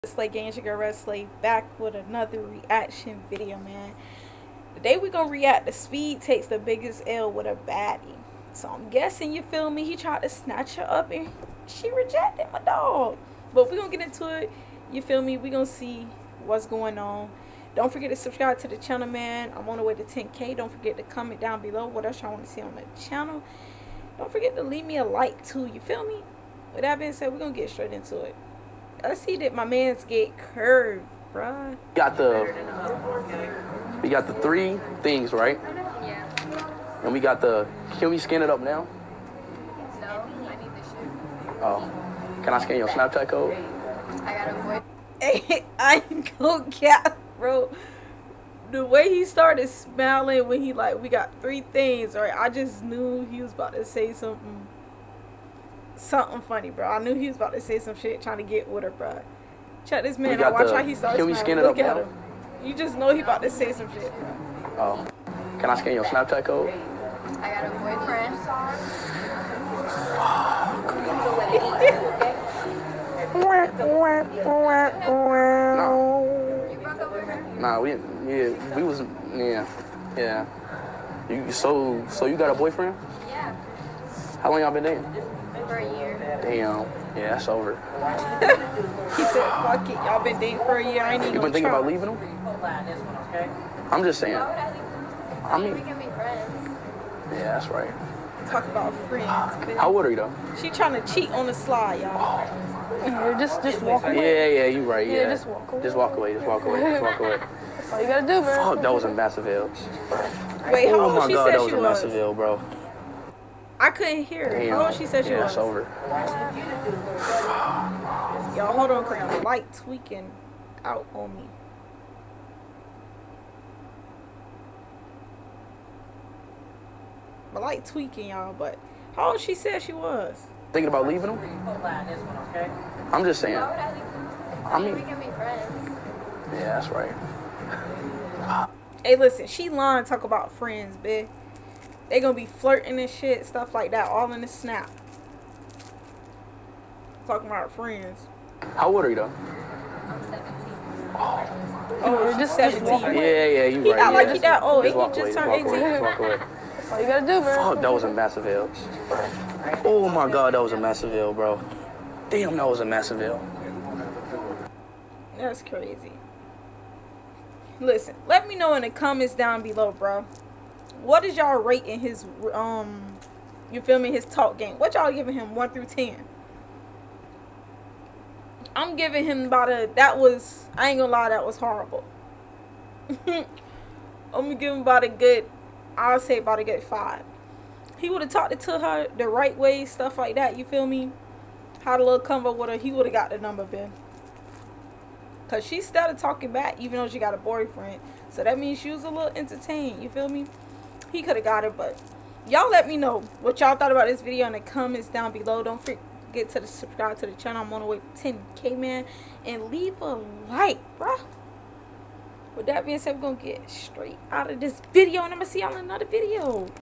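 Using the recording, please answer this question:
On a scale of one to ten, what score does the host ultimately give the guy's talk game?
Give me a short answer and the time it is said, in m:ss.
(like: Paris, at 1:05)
5, at 3:06.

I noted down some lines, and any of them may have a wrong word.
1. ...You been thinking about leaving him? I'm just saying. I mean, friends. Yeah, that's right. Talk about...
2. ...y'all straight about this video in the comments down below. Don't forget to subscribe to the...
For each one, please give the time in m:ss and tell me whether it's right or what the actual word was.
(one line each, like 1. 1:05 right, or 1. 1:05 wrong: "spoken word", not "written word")
1. 1:31 right
2. 3:23 wrong: "thought", not "straight".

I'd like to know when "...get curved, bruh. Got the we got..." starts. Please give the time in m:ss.
0:30.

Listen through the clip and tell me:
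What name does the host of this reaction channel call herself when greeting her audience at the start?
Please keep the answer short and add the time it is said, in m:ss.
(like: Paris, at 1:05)
Red Slay, at 0:00.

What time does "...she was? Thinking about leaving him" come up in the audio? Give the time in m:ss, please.
2:09.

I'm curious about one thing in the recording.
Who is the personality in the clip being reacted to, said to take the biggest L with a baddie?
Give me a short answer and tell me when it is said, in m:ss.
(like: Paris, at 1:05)
Speed, at 0:05.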